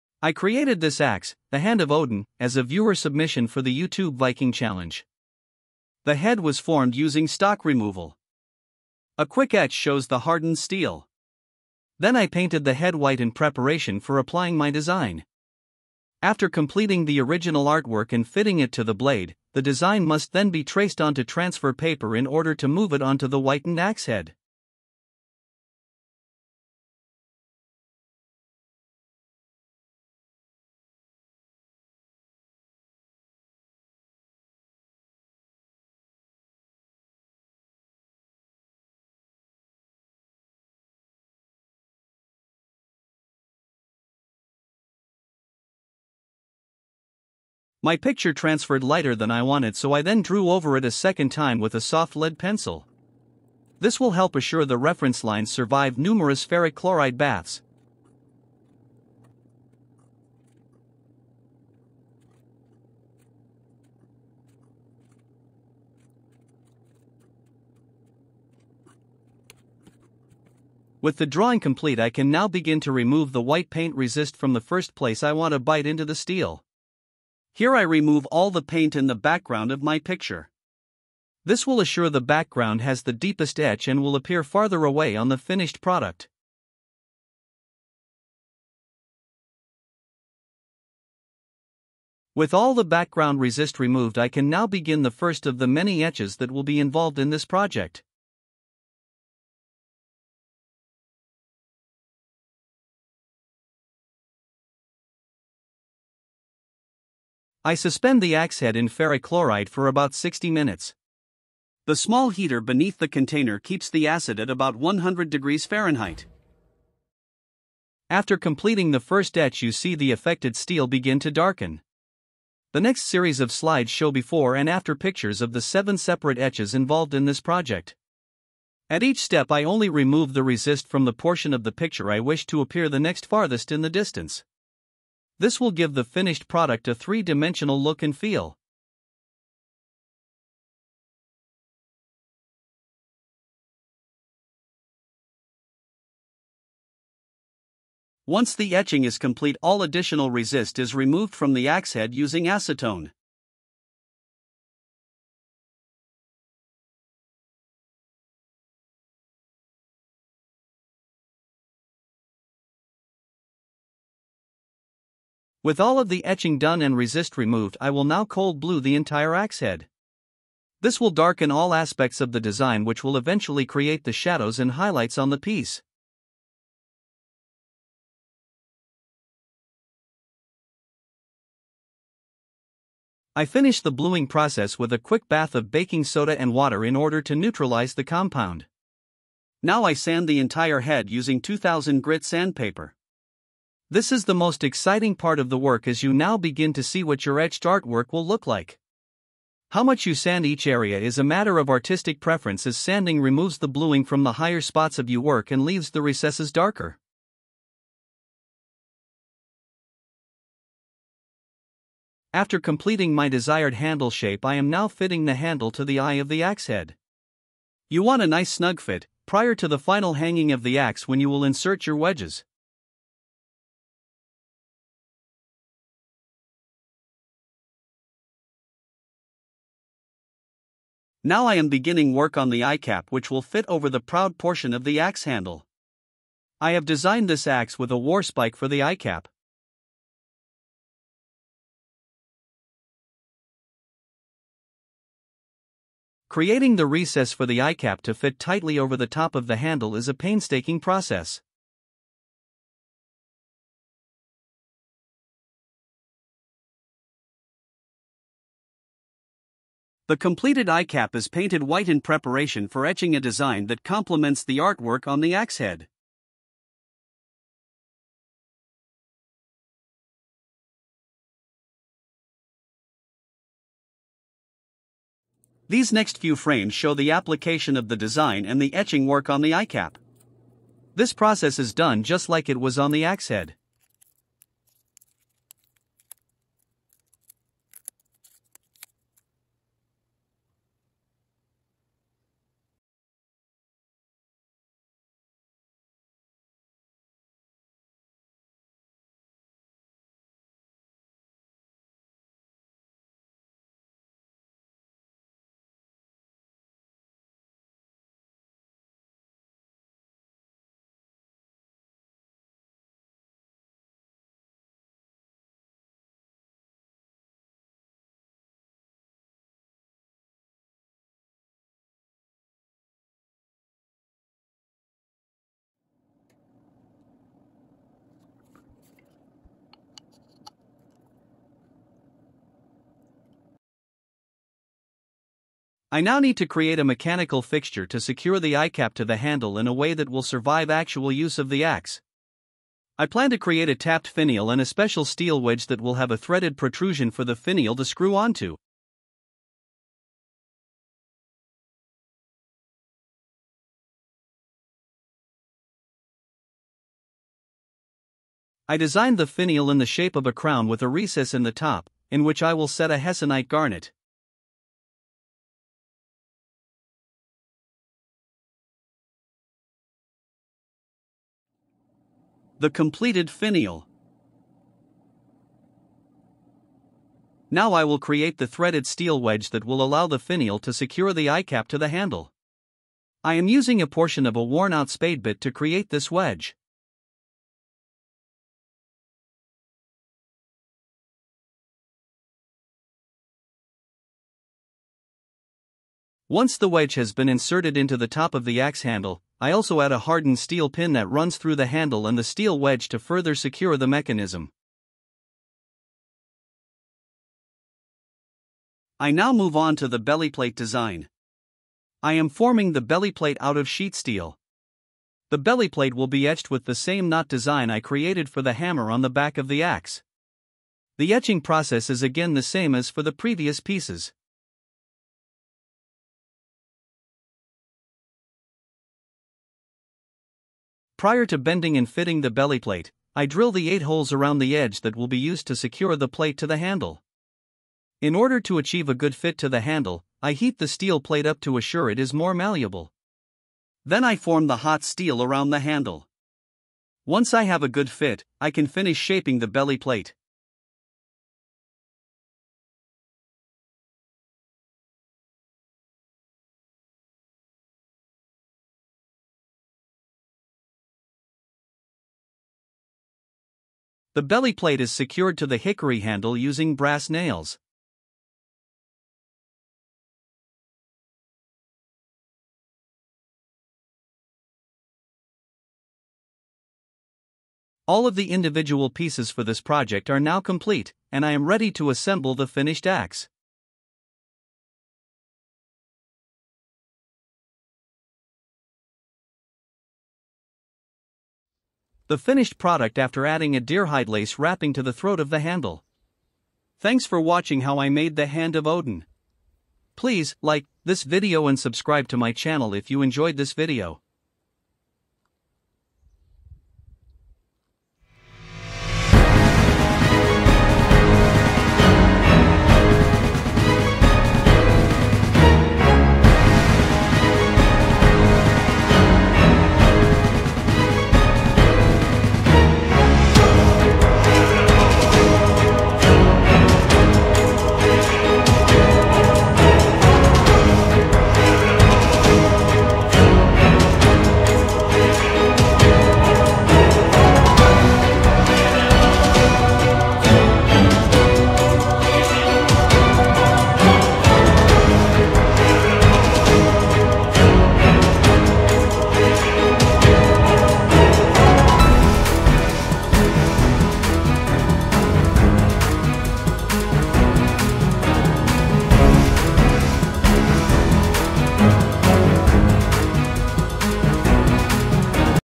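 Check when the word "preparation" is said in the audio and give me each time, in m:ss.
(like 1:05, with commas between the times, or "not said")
0:13, 4:22.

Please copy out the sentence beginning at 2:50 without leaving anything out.
This will darken all aspects of the design which will eventually create the shadows and highlights on the piece.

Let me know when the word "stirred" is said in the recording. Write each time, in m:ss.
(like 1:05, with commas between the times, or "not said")
not said.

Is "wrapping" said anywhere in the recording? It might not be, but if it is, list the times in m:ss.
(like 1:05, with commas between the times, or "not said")
8:14.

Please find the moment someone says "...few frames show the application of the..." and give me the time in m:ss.
4:36.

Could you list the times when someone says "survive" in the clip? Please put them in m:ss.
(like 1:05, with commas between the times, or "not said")
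0:55, 5:40.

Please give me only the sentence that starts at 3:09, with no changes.
Now I sand the entire head using 2000 grit sandpaper.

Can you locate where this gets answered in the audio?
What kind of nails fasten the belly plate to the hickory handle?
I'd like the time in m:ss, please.
7:46.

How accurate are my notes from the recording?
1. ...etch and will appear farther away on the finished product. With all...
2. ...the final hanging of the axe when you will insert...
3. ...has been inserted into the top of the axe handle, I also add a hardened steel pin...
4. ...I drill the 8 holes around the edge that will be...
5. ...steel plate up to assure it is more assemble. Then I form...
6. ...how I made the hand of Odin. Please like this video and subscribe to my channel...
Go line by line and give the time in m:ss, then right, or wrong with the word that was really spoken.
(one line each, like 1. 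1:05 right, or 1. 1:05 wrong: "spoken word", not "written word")
1. 1:23 right
2. 3:39 right
3. 6:36 right
4. 7:13 right
5. 7:20 wrong: "malleable", not "assemble"
6. 8:17 right.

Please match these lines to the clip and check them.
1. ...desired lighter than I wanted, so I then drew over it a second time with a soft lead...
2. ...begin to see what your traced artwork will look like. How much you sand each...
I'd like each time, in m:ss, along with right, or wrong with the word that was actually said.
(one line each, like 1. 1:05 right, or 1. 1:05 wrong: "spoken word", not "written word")
1. 0:48 wrong: "transferred", not "desired"
2. 3:16 wrong: "etched", not "traced".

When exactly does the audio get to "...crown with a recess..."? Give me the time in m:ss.
6:00.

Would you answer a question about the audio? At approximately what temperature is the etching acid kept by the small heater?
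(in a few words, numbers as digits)
100 degrees Fahrenheit.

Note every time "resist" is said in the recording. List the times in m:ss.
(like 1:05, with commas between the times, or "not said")
1:13, 1:33, 2:10, 2:30, 2:46.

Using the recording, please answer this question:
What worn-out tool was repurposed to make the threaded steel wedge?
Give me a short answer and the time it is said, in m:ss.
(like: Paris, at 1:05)
spade bit, at 6:24.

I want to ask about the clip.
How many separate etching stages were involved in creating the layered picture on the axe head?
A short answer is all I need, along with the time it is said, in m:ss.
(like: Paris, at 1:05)
7, at 2:05.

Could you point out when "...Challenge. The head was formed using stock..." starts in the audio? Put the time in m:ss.
0:04.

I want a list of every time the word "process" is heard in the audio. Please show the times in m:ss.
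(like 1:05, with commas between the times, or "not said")
3:04, 4:10, 4:41, 7:01.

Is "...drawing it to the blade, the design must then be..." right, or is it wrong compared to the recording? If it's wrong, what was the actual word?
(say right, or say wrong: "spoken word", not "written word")
wrong: "fitting", not "drawing".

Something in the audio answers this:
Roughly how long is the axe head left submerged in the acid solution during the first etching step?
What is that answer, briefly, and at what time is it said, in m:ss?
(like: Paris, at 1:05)
60 minutes, at 1:49.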